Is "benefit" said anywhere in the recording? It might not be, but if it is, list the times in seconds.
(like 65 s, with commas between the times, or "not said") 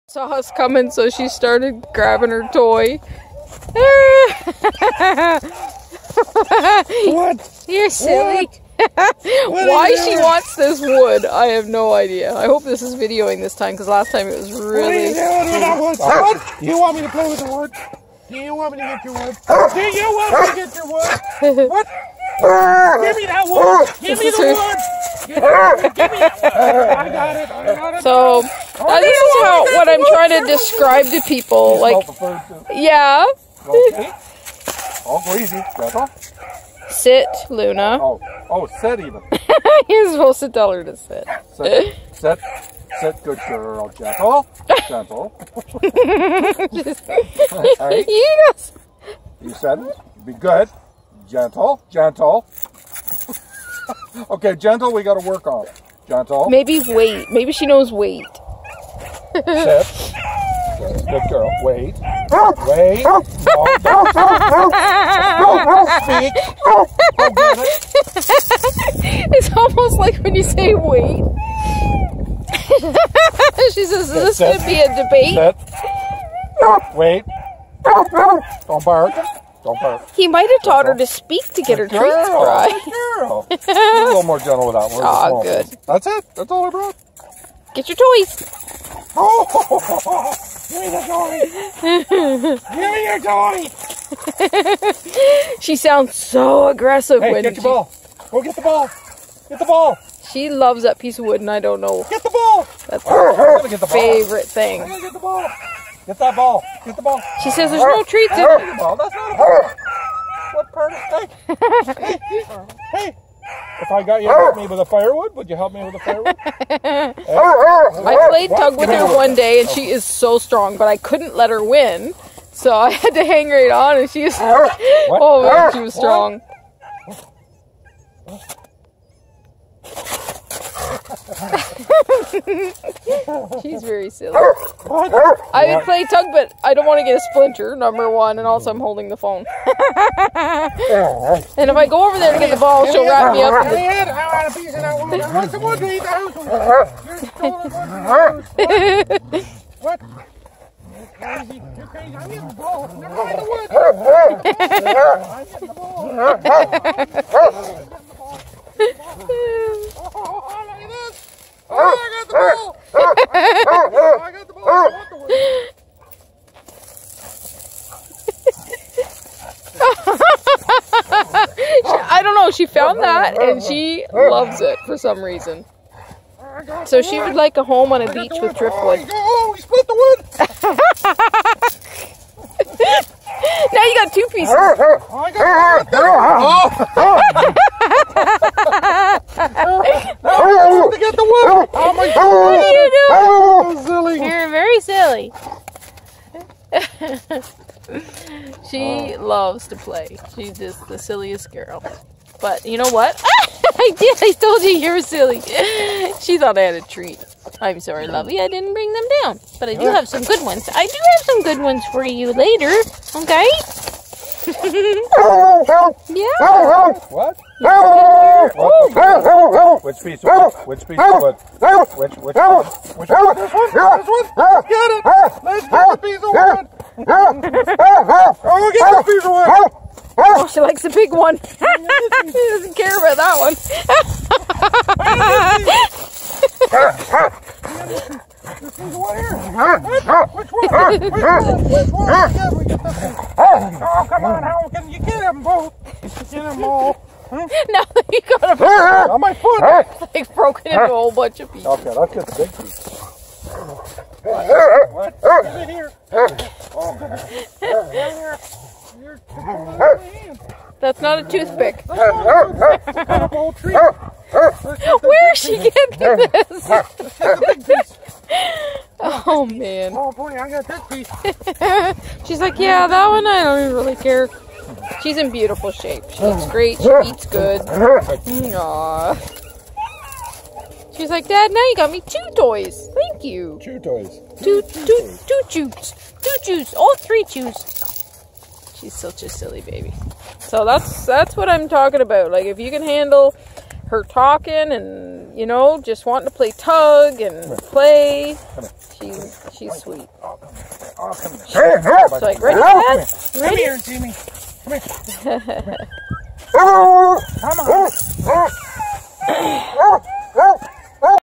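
not said.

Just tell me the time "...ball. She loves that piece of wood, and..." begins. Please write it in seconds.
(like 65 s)
99 s.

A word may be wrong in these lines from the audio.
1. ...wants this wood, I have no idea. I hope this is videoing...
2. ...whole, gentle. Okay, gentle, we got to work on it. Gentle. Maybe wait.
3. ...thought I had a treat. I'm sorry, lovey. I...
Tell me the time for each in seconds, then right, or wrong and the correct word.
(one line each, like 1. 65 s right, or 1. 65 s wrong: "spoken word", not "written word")
1. 10 s right
2. 51 s wrong: "gentle", not "whole"
3. 206 s right.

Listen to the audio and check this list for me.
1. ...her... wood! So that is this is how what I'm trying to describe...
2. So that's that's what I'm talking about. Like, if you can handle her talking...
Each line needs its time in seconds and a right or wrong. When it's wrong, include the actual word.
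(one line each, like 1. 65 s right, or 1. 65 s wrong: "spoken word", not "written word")
1. 24 s right
2. 290 s right.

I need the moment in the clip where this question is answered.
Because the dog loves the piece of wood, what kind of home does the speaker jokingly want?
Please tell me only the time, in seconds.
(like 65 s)
177 s.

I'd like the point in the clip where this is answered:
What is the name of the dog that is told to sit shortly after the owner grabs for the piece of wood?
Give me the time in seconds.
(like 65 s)
37 s.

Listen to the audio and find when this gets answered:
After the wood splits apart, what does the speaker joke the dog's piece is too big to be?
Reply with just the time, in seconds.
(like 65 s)
261 s.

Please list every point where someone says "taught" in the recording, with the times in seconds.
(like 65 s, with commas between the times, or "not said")
80 s.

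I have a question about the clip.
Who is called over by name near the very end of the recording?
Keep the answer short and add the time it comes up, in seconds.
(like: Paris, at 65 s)
Jimmy, at 303 s.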